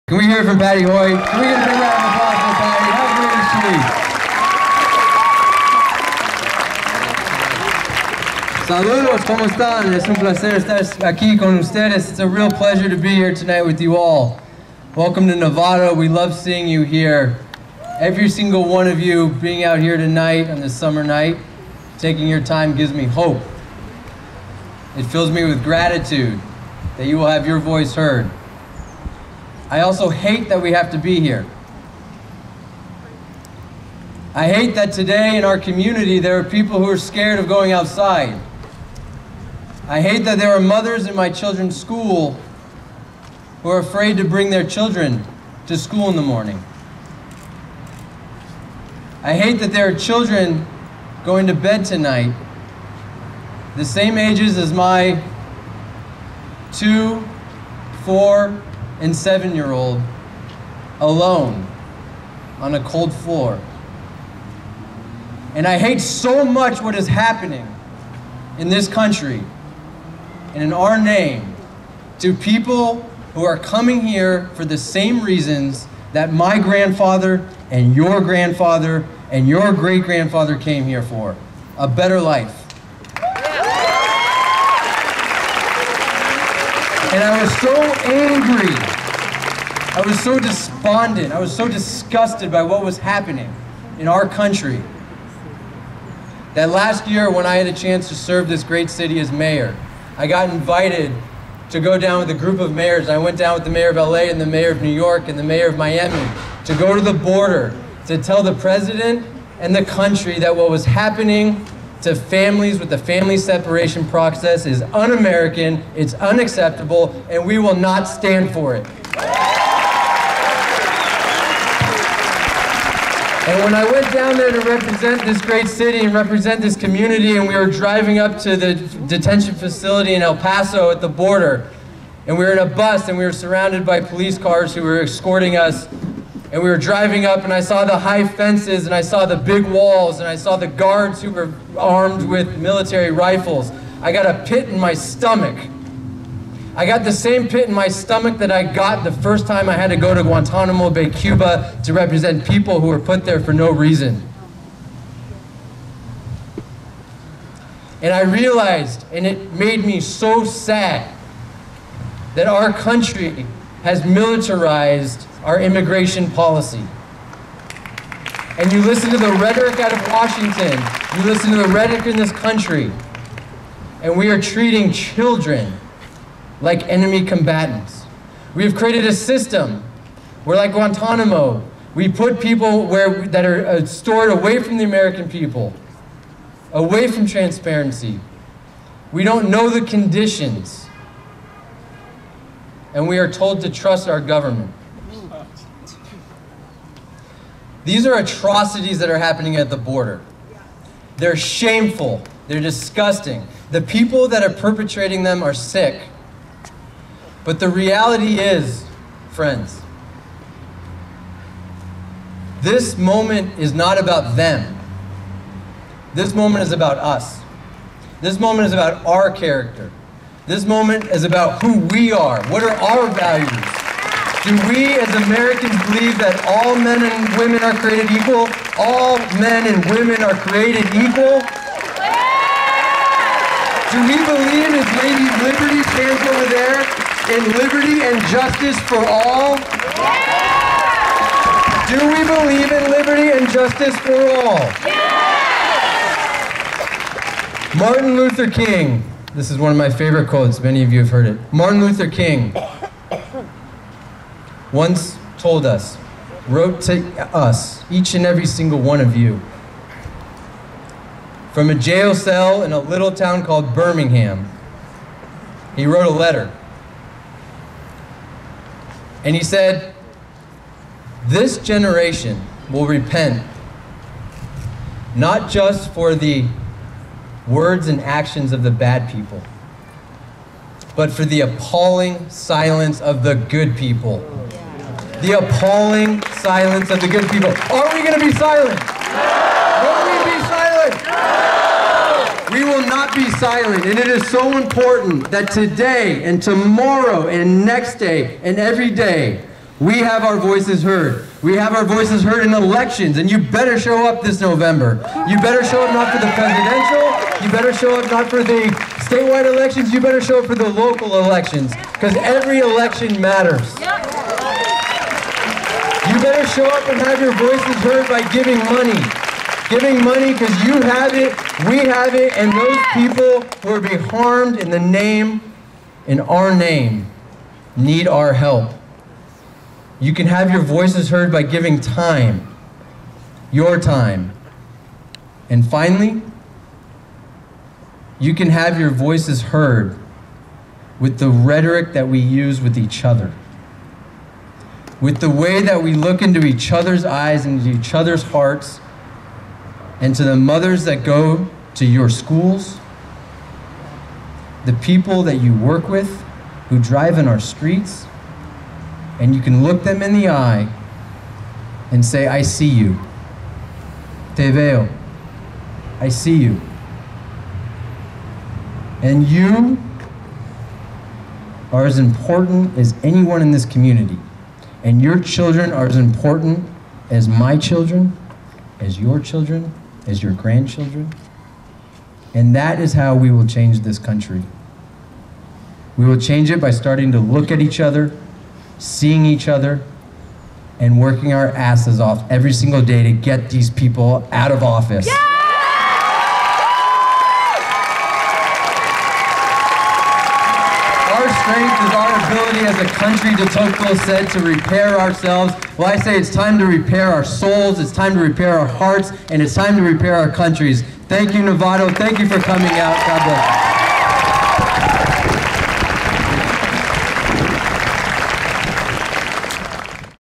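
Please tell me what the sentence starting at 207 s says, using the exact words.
But the reality is, friends, this moment is not about them.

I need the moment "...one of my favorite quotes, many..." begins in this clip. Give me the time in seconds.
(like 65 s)
249 s.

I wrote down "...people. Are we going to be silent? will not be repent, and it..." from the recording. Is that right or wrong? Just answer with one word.
wrong.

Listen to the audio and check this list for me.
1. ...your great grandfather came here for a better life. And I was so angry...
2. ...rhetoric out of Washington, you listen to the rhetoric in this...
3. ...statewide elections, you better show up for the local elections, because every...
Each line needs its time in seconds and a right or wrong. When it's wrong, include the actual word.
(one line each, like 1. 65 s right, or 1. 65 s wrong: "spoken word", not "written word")
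1. 79 s right
2. 169 s right
3. 309 s right.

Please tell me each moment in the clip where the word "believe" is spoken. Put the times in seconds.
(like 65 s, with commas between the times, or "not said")
225 s, 234 s, 242 s.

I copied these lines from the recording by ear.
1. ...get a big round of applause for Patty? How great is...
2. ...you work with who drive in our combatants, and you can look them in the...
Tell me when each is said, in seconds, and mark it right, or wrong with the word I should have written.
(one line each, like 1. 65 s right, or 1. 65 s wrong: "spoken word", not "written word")
1. 1 s right
2. 355 s wrong: "streets", not "combatants".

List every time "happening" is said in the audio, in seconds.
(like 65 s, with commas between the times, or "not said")
67 s, 92 s, 110 s, 199 s.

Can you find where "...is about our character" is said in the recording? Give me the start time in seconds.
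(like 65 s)
218 s.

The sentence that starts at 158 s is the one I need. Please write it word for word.
And I realized, and it made me so sad, that our country has militarized our immigration policy.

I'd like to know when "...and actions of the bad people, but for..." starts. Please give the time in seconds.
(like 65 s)
277 s.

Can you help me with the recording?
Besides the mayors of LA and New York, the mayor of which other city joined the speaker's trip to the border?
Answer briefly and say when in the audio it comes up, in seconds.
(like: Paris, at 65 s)
Miami, at 105 s.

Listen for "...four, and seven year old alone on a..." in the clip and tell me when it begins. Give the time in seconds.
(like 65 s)
58 s.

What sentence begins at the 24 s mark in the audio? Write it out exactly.
It fills me with gratitude that you will have your voice heard.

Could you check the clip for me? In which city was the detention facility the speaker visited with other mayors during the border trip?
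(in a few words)
El Paso.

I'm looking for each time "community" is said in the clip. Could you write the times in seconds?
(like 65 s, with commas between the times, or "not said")
35 s, 126 s, 373 s.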